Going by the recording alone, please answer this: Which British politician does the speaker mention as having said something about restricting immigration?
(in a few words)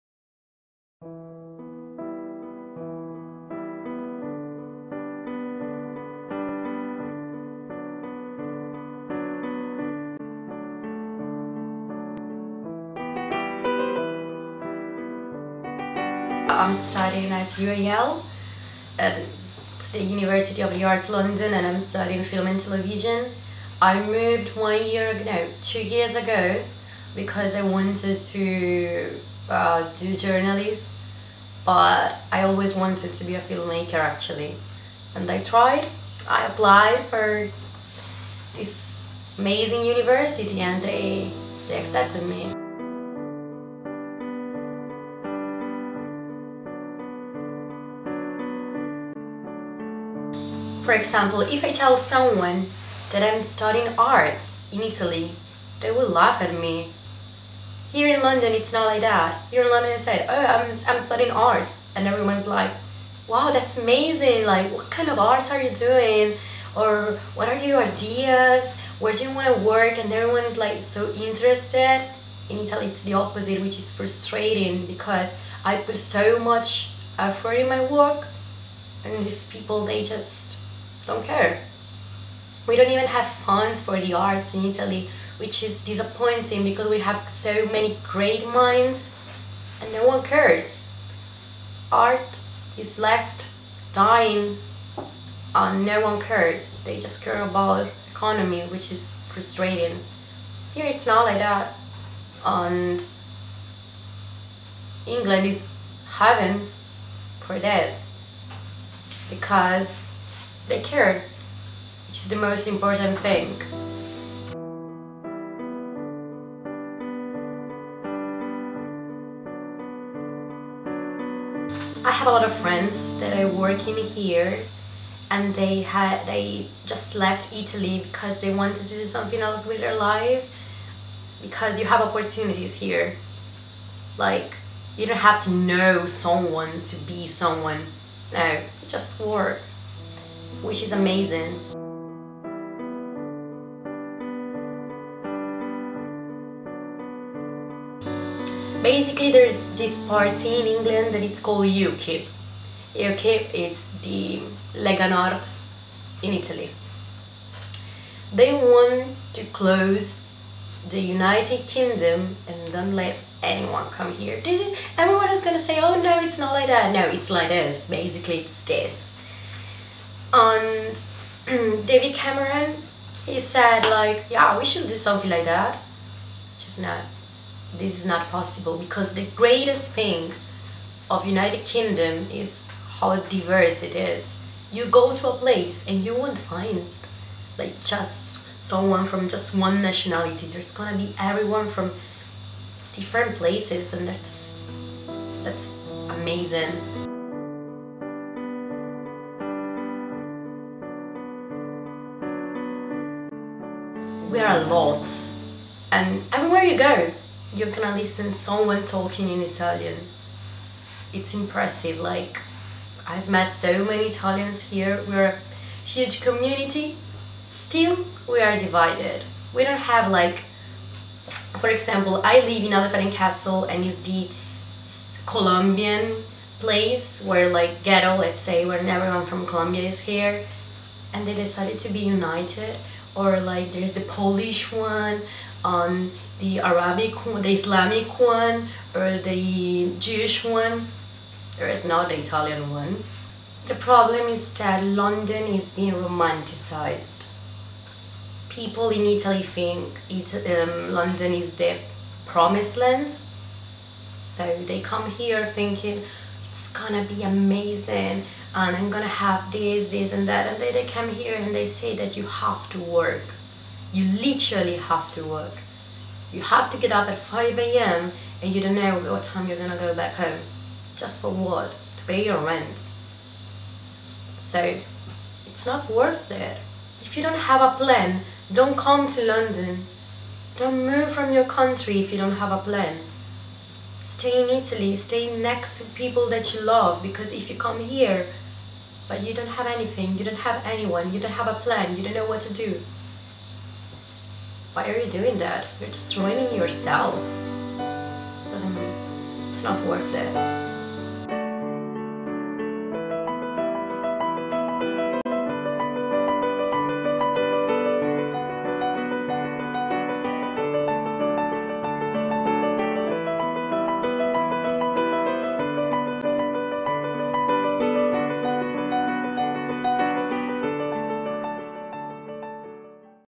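David Cameron.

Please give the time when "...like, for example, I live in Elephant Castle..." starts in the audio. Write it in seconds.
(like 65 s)
220 s.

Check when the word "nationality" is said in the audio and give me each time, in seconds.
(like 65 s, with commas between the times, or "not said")
189 s.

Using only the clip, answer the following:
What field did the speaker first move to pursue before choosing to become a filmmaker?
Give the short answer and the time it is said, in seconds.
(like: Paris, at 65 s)
Journalism, at 30 s.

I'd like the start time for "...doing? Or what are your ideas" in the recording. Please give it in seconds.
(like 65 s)
65 s.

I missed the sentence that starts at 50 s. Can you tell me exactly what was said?
for example, if I tell someone that I'm studying arts in Italy, they will laugh at me.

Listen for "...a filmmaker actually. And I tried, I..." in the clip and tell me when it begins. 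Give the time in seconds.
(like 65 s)
33 s.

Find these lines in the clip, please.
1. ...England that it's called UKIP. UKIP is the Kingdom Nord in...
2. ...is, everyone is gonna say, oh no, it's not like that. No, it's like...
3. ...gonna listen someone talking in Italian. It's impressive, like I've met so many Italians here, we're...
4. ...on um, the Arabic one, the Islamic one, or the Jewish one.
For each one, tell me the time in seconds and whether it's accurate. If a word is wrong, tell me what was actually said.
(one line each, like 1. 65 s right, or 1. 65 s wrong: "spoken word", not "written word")
1. 150 s wrong: "Lega", not "Kingdom"
2. 164 s right
3. 207 s right
4. 235 s right.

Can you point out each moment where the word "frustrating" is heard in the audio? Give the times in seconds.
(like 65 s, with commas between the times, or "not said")
73 s, 99 s.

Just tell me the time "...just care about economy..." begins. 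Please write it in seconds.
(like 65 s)
96 s.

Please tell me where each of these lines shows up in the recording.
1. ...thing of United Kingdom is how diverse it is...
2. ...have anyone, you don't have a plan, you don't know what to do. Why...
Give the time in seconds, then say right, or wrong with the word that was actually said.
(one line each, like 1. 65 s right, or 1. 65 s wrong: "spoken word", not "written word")
1. 179 s right
2. 290 s right.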